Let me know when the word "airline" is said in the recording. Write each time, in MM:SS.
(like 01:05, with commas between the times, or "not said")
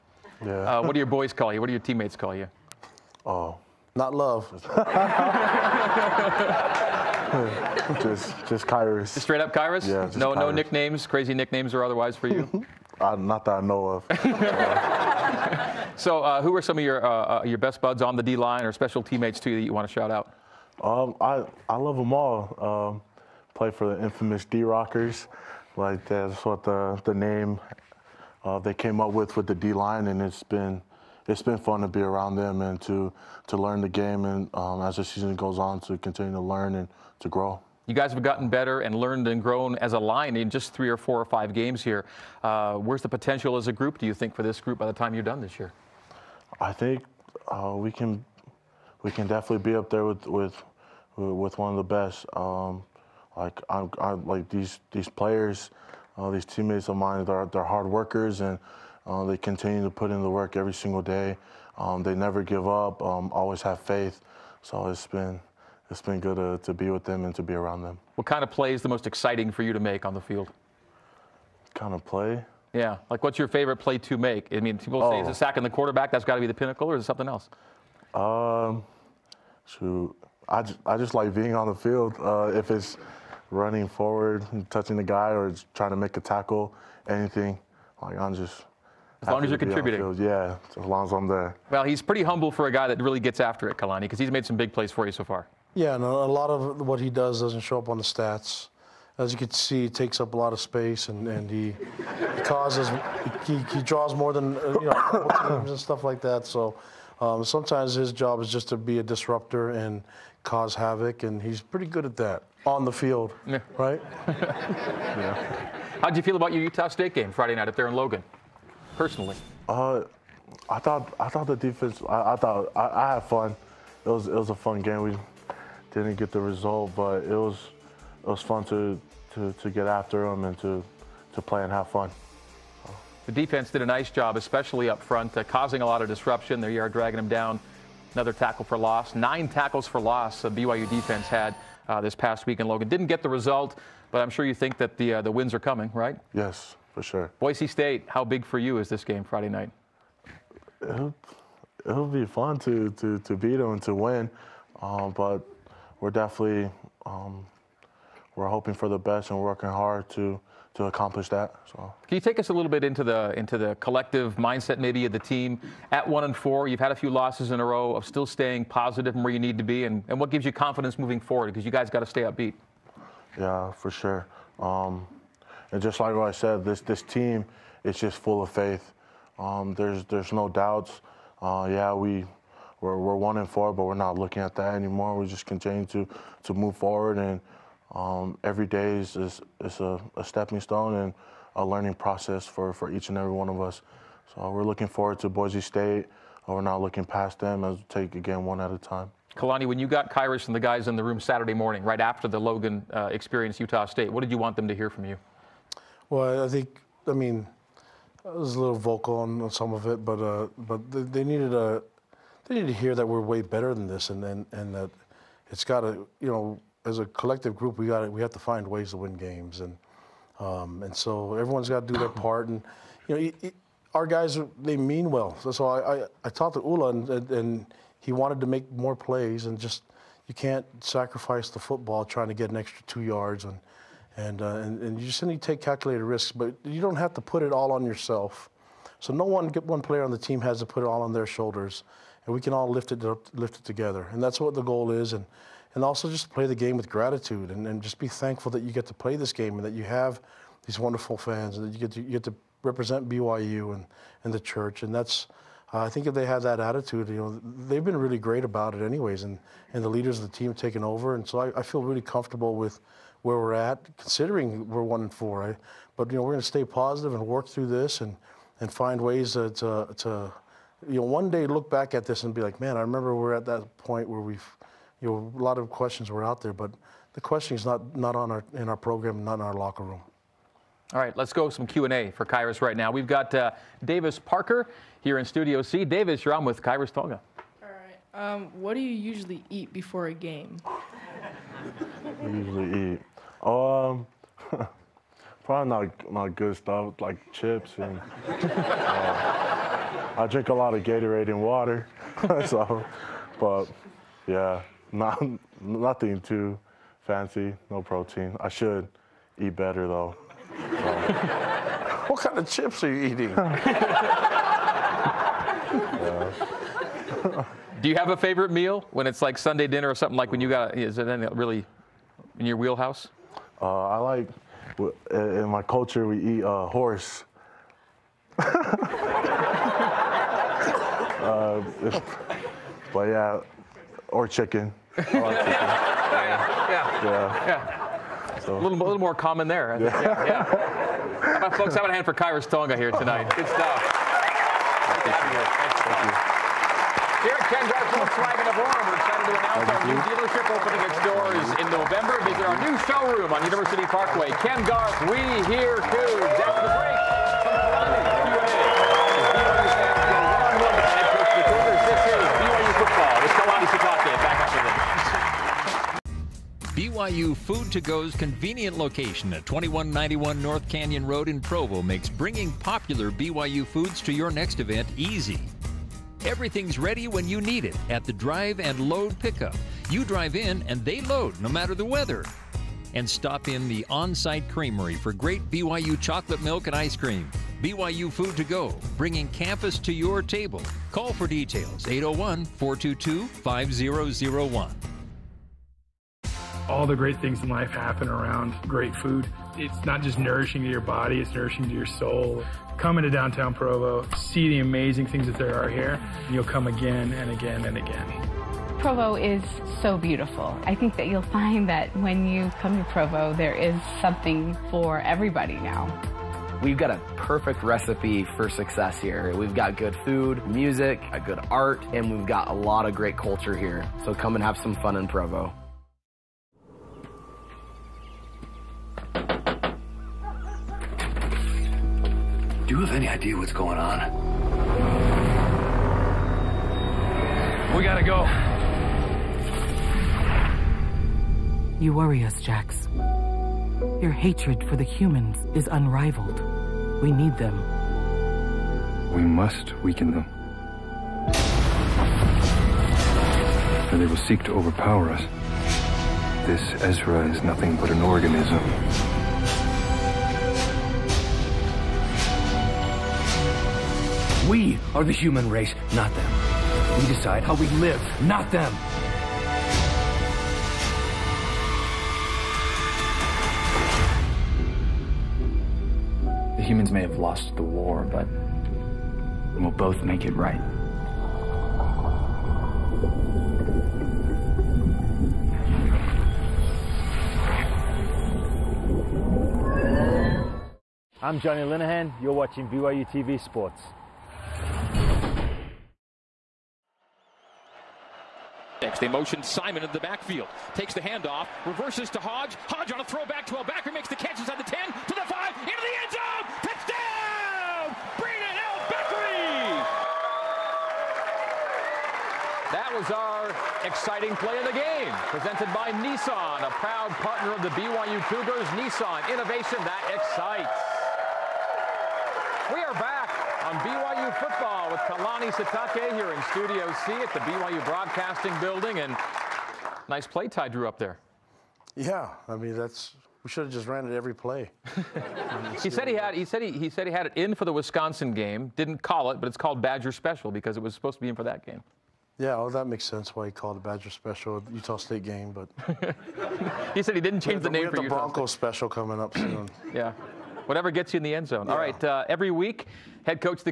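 not said.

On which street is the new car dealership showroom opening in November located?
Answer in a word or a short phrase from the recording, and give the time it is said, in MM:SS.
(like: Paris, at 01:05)
University Parkway, at 05:53.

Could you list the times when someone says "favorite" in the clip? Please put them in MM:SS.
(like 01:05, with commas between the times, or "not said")
01:13, 05:18.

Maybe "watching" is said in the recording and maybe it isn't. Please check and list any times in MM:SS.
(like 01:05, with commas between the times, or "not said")
08:12.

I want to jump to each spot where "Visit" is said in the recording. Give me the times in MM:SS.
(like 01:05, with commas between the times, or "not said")
05:52.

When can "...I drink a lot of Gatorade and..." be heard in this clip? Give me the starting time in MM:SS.
05:00.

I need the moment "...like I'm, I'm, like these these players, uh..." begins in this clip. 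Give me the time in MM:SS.
00:53.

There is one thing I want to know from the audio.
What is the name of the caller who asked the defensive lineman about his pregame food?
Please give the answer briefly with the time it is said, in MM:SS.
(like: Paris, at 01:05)
Davis Parker, at 04:43.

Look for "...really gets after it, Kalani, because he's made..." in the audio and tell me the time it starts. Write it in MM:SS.
01:33.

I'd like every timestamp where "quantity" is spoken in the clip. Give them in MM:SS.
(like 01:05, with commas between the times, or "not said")
not said.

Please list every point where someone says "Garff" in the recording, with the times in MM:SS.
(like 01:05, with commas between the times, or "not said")
05:54.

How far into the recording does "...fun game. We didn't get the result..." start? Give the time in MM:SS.
02:04.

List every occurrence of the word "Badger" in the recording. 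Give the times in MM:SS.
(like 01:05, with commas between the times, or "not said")
08:59, 09:03.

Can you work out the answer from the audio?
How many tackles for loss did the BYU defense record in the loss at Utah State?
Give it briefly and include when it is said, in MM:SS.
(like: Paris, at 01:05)
9, at 02:19.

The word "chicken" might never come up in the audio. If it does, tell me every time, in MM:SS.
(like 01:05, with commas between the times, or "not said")
05:34.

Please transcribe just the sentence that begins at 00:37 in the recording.
You guys have gotten better and learned and grown as a line in just three or four or five games here.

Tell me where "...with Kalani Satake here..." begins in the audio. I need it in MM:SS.
08:44.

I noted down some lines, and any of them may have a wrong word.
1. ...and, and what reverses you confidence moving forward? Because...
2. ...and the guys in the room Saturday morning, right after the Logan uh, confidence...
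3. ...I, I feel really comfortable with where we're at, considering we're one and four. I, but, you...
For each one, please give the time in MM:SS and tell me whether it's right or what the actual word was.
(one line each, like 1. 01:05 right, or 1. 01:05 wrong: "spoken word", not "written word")
1. 02:49 wrong: "gives", not "reverses"
2. 03:20 wrong: "experience", not "confidence"
3. 04:21 right.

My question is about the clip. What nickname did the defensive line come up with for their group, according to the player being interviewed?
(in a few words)
D Rockers.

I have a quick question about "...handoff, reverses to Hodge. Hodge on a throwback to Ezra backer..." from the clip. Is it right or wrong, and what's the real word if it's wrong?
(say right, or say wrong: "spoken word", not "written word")
wrong: "Albacker", not "Ezra".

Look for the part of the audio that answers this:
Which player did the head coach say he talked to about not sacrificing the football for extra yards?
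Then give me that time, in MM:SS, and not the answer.
03:46.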